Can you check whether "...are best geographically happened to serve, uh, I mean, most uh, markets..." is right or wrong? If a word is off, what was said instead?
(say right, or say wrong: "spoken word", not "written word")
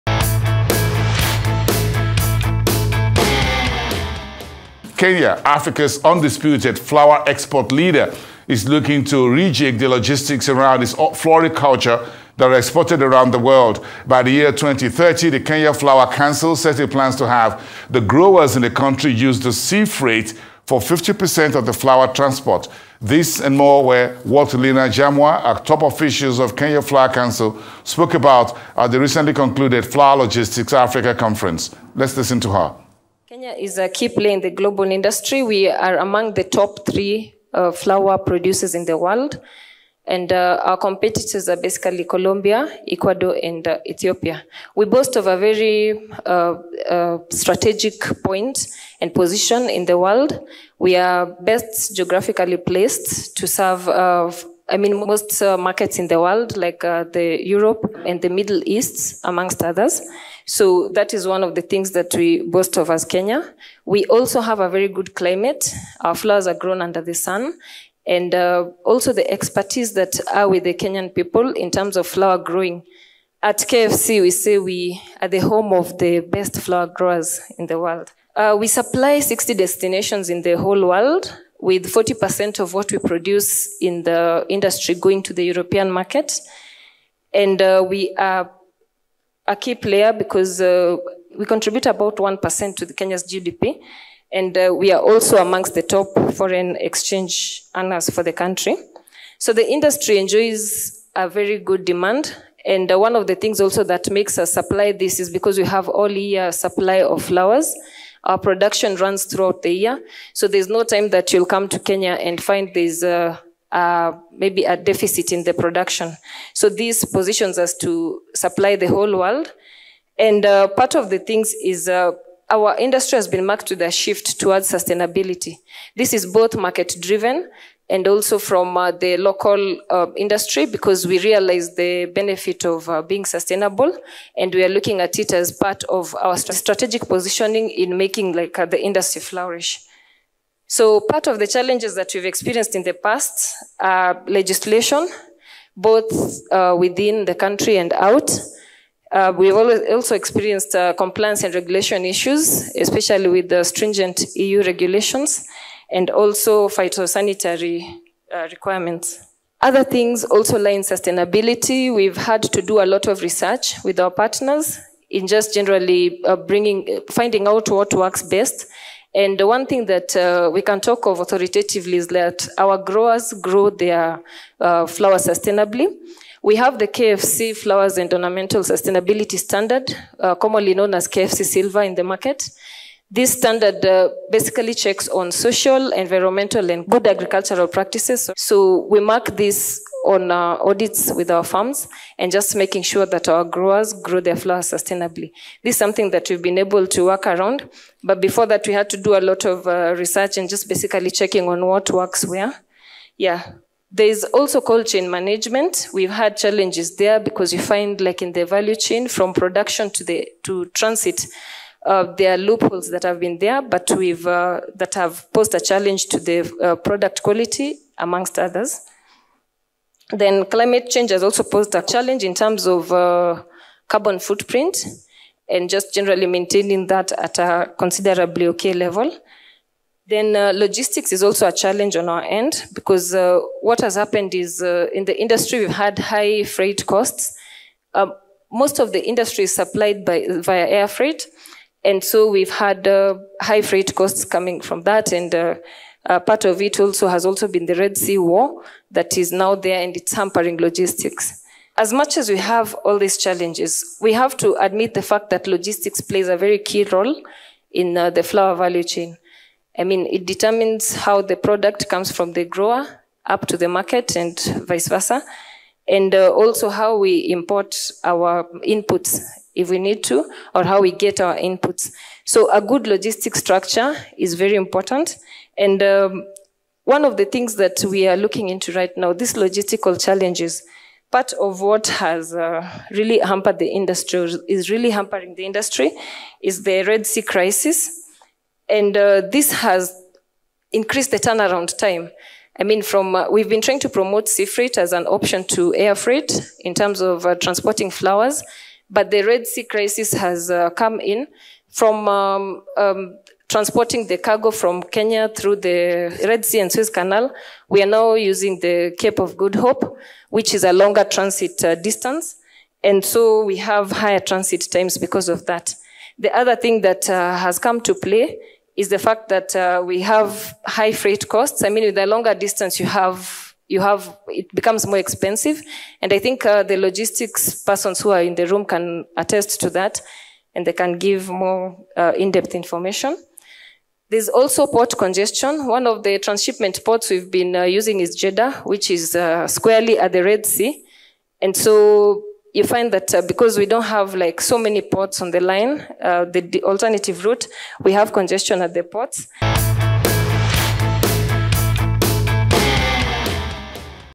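wrong: "placed", not "happened".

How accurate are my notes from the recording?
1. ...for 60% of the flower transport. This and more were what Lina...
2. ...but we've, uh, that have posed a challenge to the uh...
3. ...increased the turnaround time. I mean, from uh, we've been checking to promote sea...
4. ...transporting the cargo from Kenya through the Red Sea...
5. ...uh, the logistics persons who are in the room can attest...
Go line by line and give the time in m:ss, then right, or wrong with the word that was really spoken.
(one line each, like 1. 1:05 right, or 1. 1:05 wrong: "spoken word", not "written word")
1. 0:20 wrong: "50", not "60"
2. 3:33 right
3. 4:50 wrong: "trying", not "checking"
4. 5:03 right
5. 5:26 right.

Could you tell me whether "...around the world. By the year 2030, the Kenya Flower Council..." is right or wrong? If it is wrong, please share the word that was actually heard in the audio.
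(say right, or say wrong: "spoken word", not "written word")
right.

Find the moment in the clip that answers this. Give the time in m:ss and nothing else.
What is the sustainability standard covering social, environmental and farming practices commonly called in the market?
3:01.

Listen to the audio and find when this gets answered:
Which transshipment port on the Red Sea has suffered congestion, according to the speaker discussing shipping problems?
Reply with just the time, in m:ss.
5:38.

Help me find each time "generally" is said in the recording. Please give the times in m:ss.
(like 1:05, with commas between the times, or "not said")
2:45, 3:45.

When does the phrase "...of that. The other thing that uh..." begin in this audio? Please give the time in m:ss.
5:15.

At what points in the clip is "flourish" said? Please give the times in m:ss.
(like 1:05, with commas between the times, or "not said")
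2:19.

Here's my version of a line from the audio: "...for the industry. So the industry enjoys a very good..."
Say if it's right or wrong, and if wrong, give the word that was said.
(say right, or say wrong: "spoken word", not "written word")
wrong: "country", not "industry".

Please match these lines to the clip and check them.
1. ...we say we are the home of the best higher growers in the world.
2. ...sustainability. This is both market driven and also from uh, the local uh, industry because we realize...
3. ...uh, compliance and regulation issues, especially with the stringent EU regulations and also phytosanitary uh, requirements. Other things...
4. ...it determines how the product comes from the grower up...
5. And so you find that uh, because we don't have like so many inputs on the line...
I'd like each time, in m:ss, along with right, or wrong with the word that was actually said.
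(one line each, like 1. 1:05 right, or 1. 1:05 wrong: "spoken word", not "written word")
1. 1:14 wrong: "flower", not "higher"
2. 2:04 right
3. 2:30 right
4. 4:20 right
5. 5:41 wrong: "ports", not "inputs".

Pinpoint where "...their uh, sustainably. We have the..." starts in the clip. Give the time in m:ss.
2:53.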